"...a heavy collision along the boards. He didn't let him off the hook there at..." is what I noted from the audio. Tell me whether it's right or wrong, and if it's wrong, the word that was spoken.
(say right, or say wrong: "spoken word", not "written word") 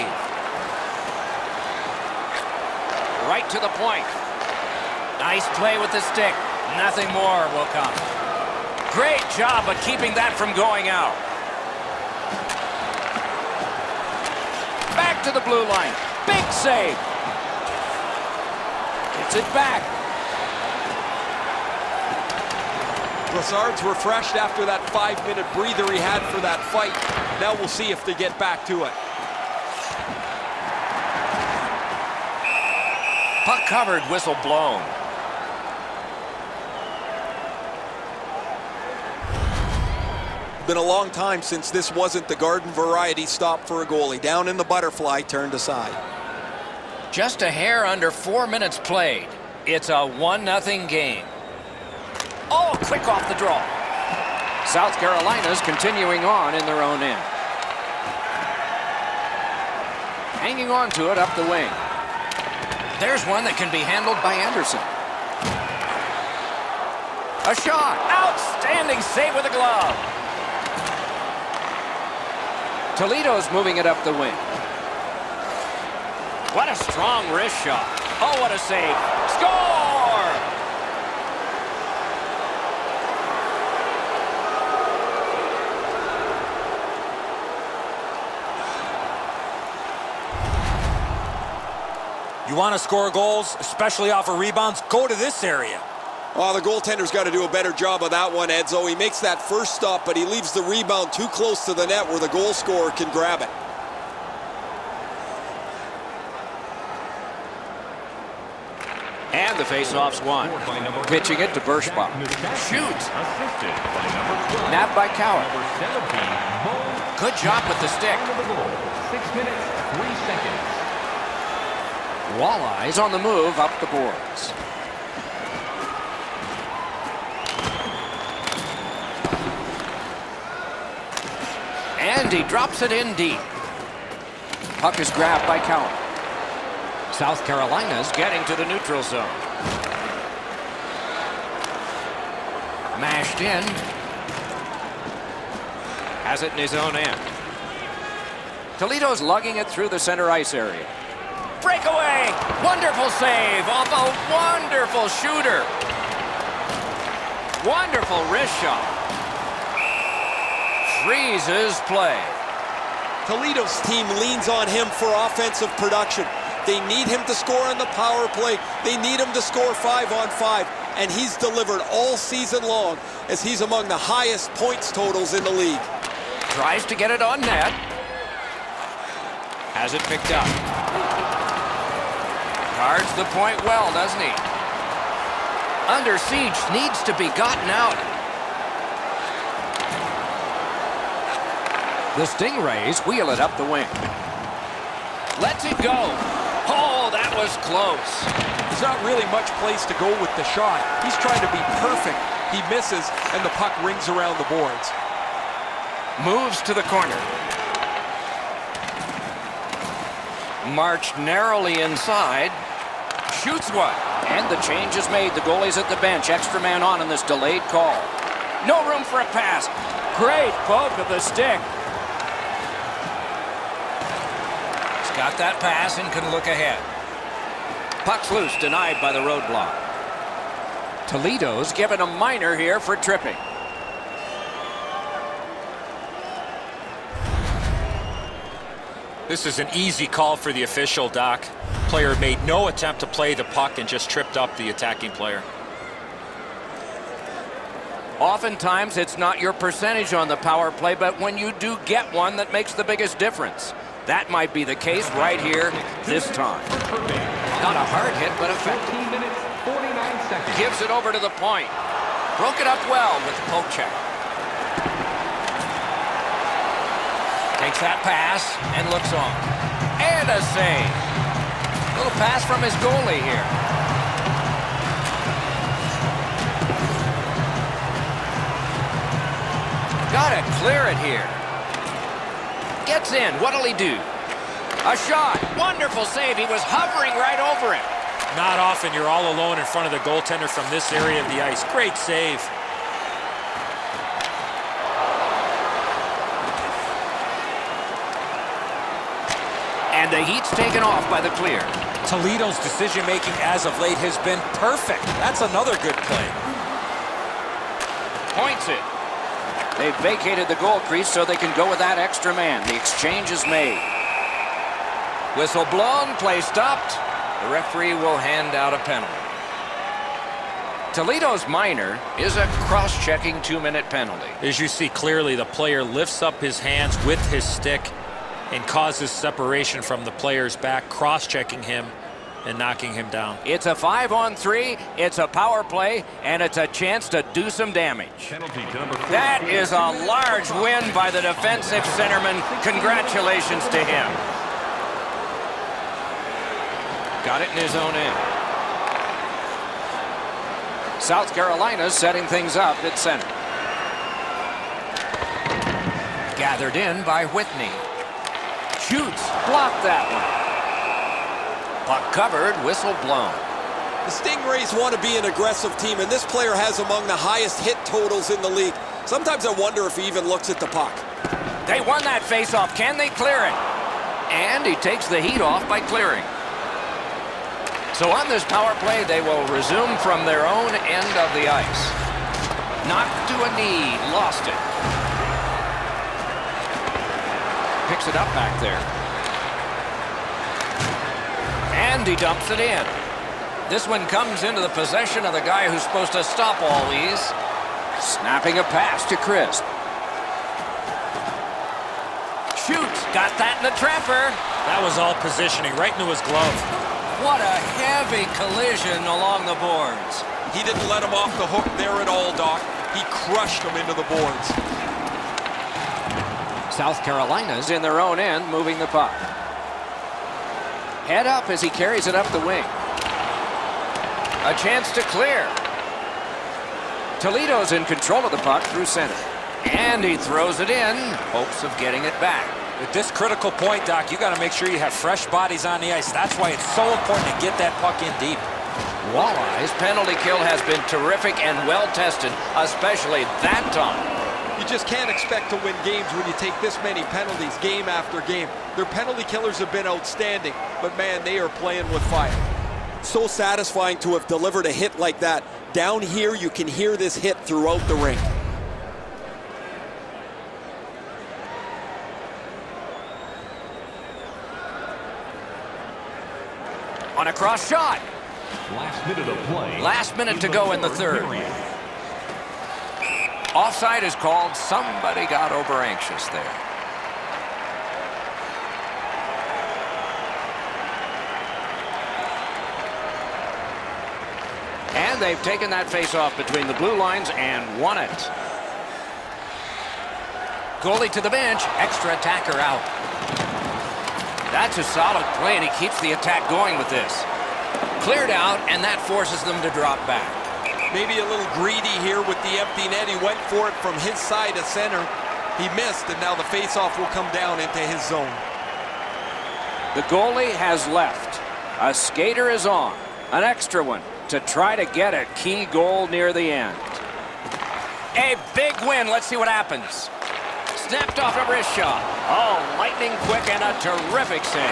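right.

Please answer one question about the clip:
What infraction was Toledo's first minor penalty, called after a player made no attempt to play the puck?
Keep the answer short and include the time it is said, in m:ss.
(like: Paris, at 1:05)
Tripping, at 3:52.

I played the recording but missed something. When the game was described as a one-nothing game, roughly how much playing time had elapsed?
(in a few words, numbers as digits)
a hair under four minutes.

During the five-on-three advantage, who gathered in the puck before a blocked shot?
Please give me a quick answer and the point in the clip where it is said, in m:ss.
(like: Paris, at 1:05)
Whitney, at 5:57.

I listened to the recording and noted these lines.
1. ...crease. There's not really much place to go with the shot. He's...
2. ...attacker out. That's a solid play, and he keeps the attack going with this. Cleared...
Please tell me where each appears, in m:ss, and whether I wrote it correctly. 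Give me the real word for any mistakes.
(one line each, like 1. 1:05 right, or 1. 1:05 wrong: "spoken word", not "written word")
1. 3:17 wrong: "close", not "crease"
2. 8:12 right.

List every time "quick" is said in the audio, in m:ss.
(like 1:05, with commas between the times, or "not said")
0:52, 8:43.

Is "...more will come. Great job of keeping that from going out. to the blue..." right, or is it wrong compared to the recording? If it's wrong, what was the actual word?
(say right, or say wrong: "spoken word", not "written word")
right.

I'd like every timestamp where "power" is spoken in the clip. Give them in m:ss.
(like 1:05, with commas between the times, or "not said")
2:47, 4:10, 5:35, 6:18.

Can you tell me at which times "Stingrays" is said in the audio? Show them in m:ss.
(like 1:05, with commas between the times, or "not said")
3:12, 6:04.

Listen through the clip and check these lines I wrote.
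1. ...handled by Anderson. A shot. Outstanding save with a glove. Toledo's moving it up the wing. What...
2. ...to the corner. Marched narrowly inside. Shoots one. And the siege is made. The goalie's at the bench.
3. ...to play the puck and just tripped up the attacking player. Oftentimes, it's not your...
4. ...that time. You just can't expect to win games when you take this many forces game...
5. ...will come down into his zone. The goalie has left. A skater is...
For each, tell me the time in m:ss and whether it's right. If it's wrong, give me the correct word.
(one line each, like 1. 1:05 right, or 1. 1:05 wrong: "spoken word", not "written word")
1. 1:03 right
2. 3:26 wrong: "change", not "siege"
3. 4:02 right
4. 7:23 wrong: "penalties", not "forces"
5. 8:26 right.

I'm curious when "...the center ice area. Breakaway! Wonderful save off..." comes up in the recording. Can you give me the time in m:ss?
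2:29.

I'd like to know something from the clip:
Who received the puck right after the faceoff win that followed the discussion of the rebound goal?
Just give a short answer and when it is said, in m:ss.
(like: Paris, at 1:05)
Bershbaum, at 1:51.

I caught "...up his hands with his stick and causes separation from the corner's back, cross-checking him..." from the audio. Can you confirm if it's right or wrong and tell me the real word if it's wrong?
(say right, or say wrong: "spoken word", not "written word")
wrong: "player", not "corner".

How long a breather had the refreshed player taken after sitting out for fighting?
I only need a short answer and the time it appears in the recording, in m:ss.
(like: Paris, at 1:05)
5 minutes, at 0:24.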